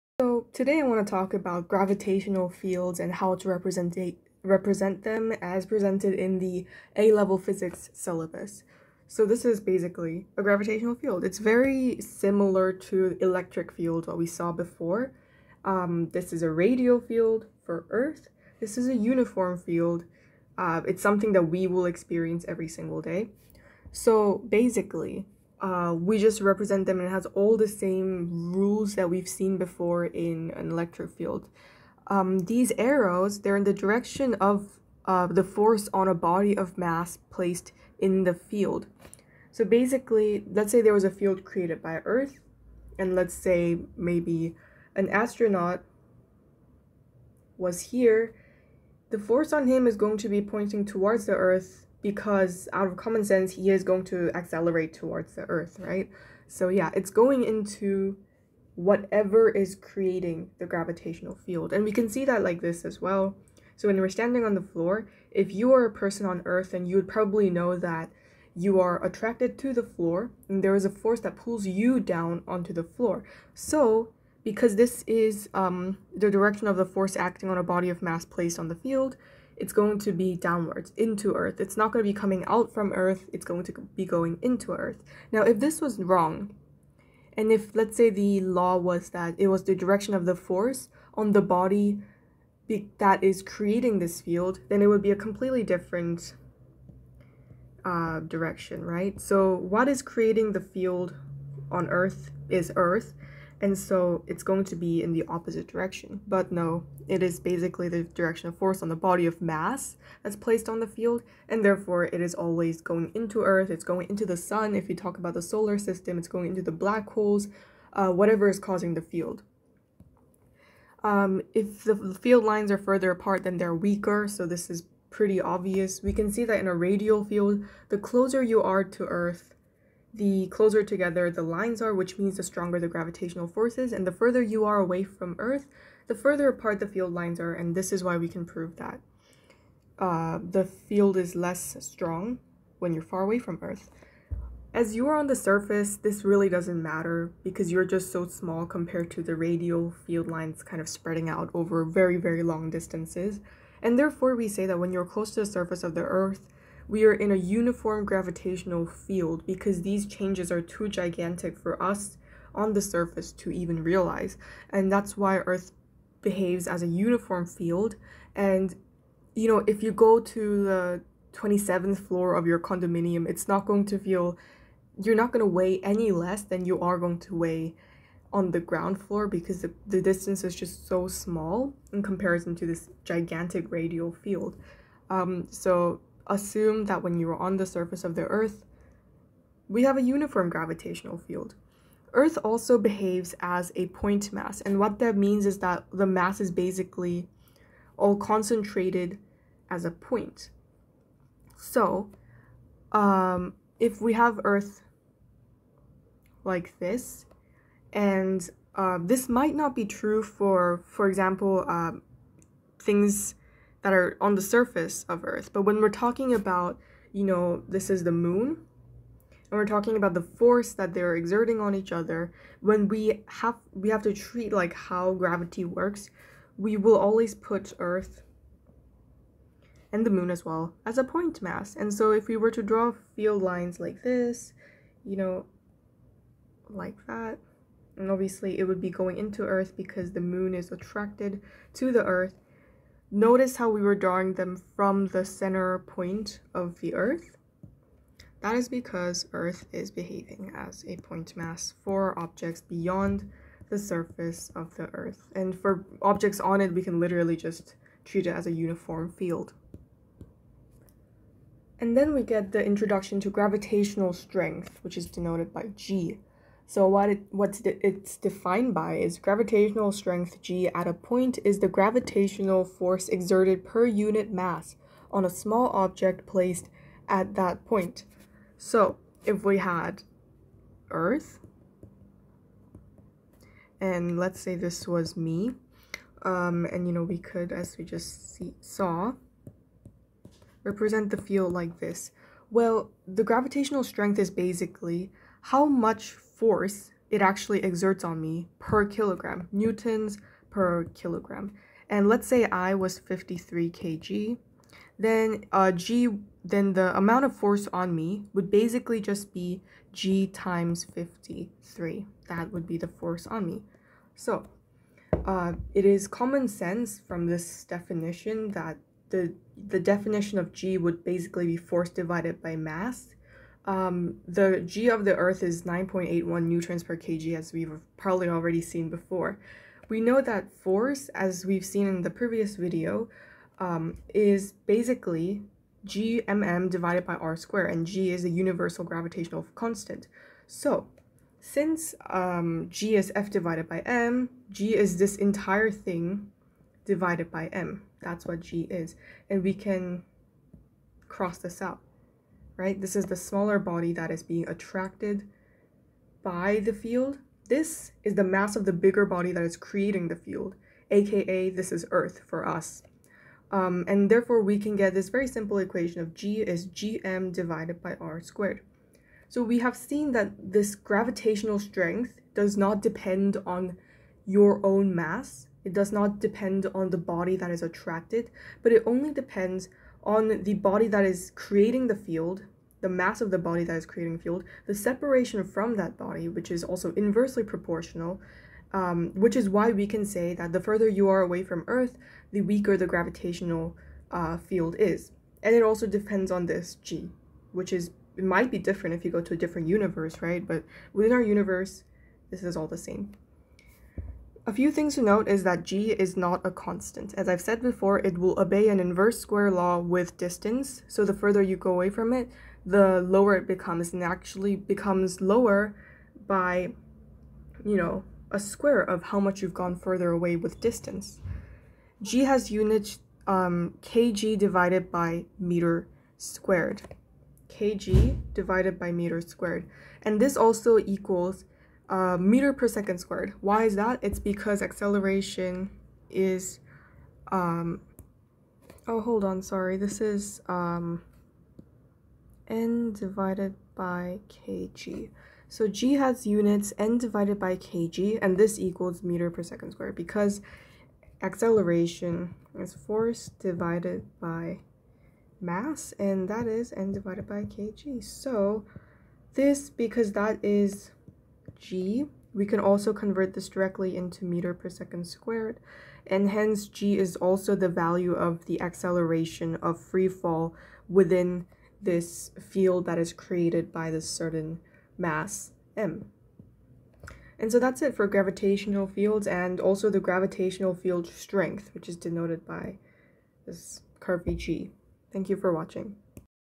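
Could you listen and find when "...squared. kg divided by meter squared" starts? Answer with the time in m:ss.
7:06.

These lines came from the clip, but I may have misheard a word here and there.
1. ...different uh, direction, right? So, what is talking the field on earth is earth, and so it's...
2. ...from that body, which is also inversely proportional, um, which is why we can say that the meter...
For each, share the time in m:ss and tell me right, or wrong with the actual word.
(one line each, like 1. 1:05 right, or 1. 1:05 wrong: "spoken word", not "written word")
1. 1:35 wrong: "creating", not "talking"
2. 6:25 wrong: "further", not "meter".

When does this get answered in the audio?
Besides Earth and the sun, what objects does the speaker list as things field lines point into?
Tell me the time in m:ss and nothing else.
1:56.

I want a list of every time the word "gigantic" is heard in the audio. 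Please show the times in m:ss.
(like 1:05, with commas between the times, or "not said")
2:40, 3:03.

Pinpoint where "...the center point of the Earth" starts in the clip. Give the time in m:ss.
4:05.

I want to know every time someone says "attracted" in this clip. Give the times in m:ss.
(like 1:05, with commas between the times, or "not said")
1:09, 4:00, 5:54, 6:17.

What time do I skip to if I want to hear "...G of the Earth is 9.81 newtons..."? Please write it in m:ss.
5:24.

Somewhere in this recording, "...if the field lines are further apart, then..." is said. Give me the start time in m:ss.
2:01.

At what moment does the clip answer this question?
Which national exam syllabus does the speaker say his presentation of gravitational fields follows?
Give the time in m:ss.
0:06.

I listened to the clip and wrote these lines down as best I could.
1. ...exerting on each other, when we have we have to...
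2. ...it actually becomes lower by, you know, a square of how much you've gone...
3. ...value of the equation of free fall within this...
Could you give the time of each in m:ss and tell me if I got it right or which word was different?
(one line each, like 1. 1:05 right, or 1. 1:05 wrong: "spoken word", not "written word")
1. 3:41 right
2. 6:54 right
3. 7:47 wrong: "acceleration", not "equation".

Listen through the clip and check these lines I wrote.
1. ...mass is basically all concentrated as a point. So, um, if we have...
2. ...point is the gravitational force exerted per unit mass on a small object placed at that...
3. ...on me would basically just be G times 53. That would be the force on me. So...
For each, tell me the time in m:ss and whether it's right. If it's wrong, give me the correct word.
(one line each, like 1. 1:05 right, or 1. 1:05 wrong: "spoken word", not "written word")
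1. 3:16 right
2. 4:30 right
3. 5:07 right.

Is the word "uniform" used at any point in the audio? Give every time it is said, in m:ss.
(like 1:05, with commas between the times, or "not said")
0:18, 2:37, 2:46, 3:10, 4:18.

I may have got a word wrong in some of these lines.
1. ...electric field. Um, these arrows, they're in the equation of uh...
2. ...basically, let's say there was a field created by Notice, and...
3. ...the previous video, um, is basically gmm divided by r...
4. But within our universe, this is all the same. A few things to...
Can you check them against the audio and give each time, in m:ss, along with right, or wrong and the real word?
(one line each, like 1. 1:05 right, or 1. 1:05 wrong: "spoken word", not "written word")
1. 0:30 wrong: "direction", not "equation"
2. 0:39 wrong: "Earth", not "Notice"
3. 5:32 right
4. 6:40 right.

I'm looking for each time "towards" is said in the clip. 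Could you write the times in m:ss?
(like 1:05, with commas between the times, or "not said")
0:50, 0:54.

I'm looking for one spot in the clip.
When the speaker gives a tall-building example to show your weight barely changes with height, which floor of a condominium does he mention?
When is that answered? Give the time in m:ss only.
2:51.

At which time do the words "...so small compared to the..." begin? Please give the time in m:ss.
2:28.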